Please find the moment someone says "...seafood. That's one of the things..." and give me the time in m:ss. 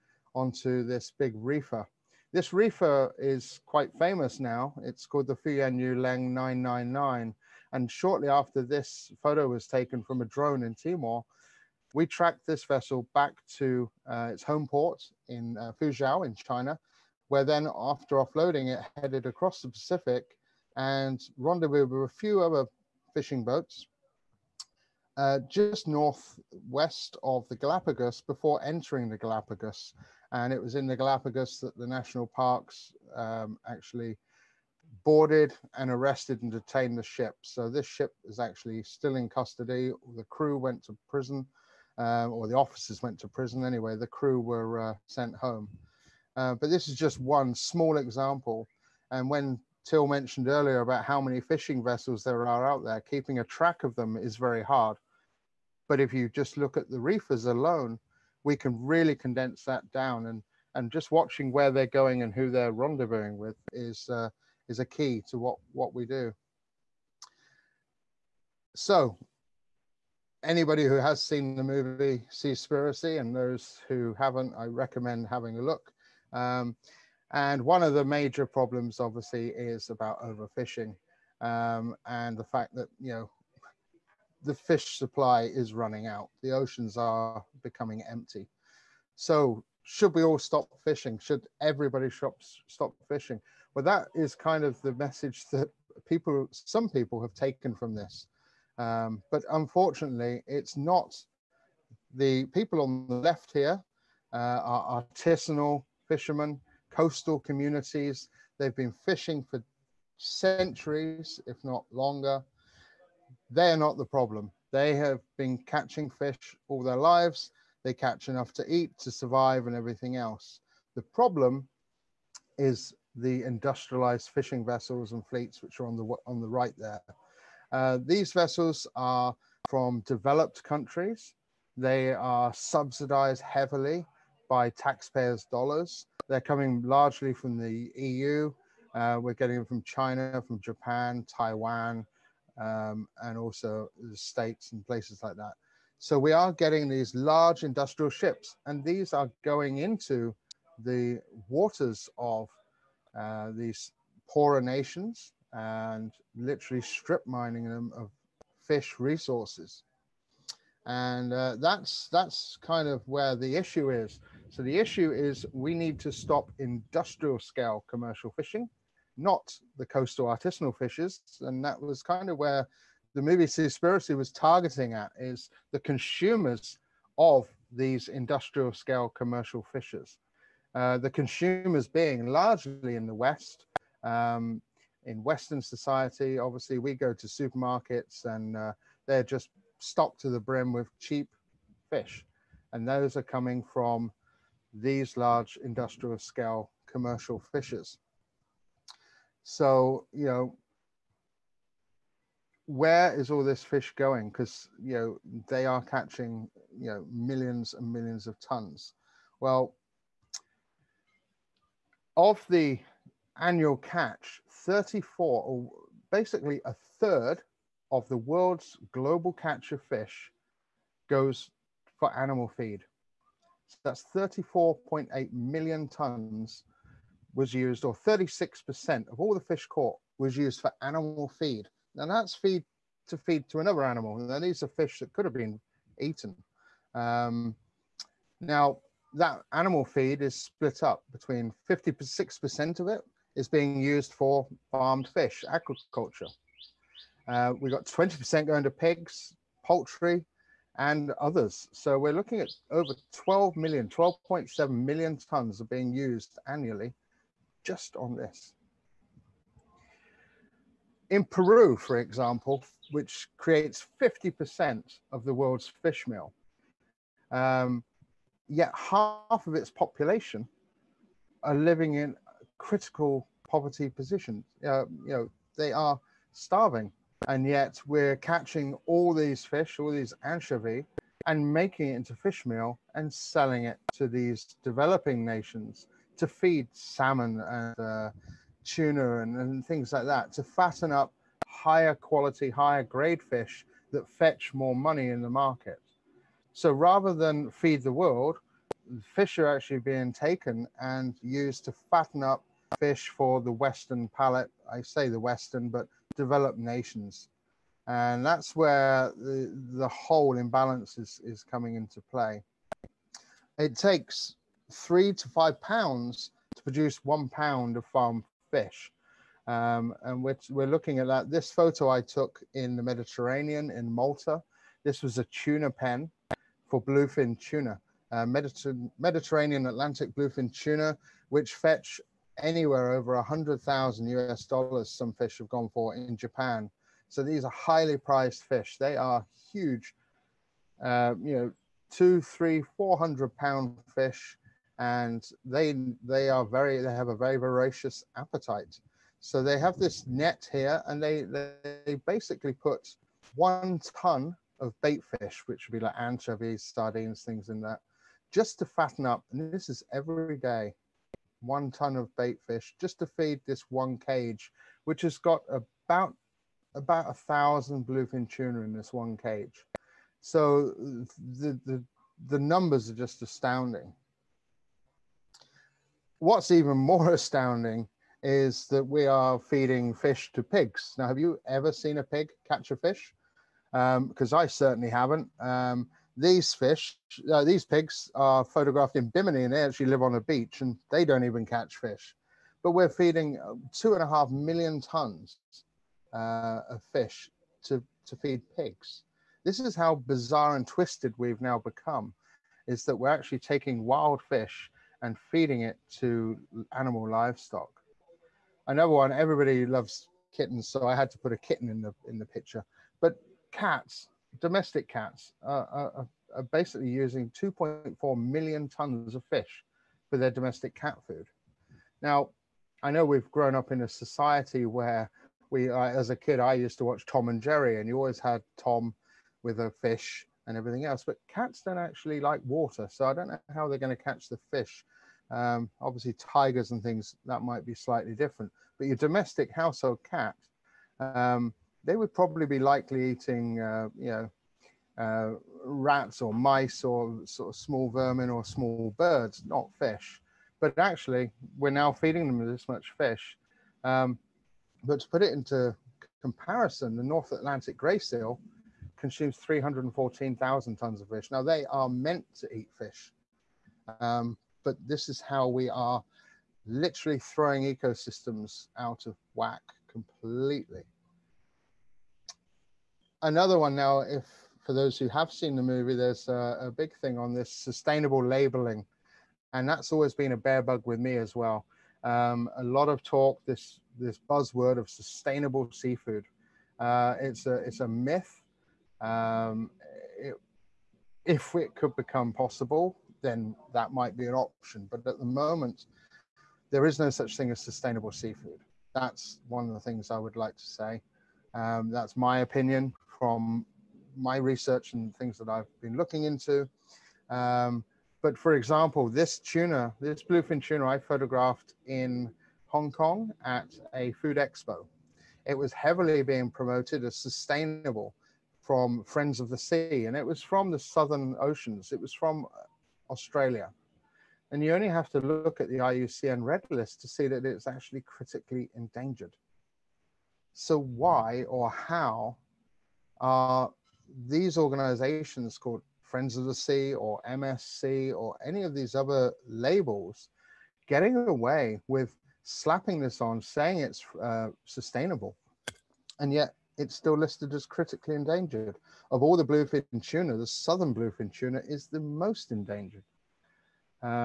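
8:18.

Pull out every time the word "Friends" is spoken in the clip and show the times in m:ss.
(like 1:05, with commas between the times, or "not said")
8:39, 8:56.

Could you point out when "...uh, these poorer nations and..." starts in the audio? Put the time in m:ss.
2:33.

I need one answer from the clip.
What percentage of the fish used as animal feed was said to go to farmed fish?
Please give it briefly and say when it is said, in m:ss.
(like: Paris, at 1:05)
56%, at 4:01.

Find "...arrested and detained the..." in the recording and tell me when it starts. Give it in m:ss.
0:35.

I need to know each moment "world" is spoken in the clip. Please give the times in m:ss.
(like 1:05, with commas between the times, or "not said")
3:38, 4:25, 4:57.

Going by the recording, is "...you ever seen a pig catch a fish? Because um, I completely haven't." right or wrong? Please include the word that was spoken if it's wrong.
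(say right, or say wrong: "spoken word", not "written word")
wrong: "certainly", not "completely".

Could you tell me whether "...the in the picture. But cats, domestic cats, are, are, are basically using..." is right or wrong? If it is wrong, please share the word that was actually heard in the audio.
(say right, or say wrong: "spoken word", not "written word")
right.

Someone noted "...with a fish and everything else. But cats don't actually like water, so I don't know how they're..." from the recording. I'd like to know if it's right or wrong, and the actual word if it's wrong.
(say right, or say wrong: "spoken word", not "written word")
right.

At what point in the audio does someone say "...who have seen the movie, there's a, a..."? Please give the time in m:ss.
7:54.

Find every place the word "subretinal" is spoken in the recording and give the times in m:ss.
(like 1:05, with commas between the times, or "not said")
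not said.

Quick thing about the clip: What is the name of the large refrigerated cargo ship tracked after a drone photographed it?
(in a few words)
Fu Yuan Yu Leng 999.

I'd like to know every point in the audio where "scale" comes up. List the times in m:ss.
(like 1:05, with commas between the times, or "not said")
2:47, 2:58, 3:16.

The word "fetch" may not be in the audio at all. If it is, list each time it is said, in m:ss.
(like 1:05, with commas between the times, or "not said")
4:54, 5:31.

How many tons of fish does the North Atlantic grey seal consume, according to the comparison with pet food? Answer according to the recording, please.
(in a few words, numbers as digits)
314,000 tons.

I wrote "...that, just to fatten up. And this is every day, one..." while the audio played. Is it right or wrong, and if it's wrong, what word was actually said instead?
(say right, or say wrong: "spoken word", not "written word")
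right.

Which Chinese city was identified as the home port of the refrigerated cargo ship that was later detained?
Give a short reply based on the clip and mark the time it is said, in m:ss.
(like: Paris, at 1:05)
Fuzhou, at 0:15.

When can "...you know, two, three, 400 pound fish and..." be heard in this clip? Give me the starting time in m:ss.
5:41.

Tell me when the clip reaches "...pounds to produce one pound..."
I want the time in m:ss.
5:15.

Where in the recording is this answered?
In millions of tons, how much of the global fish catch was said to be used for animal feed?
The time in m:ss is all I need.
3:44.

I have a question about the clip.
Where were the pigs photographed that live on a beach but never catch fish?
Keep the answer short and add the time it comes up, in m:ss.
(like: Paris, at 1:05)
Bimini, at 6:29.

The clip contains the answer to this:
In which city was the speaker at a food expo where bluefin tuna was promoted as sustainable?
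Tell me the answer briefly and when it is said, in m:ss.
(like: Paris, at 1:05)
Hong Kong, at 8:32.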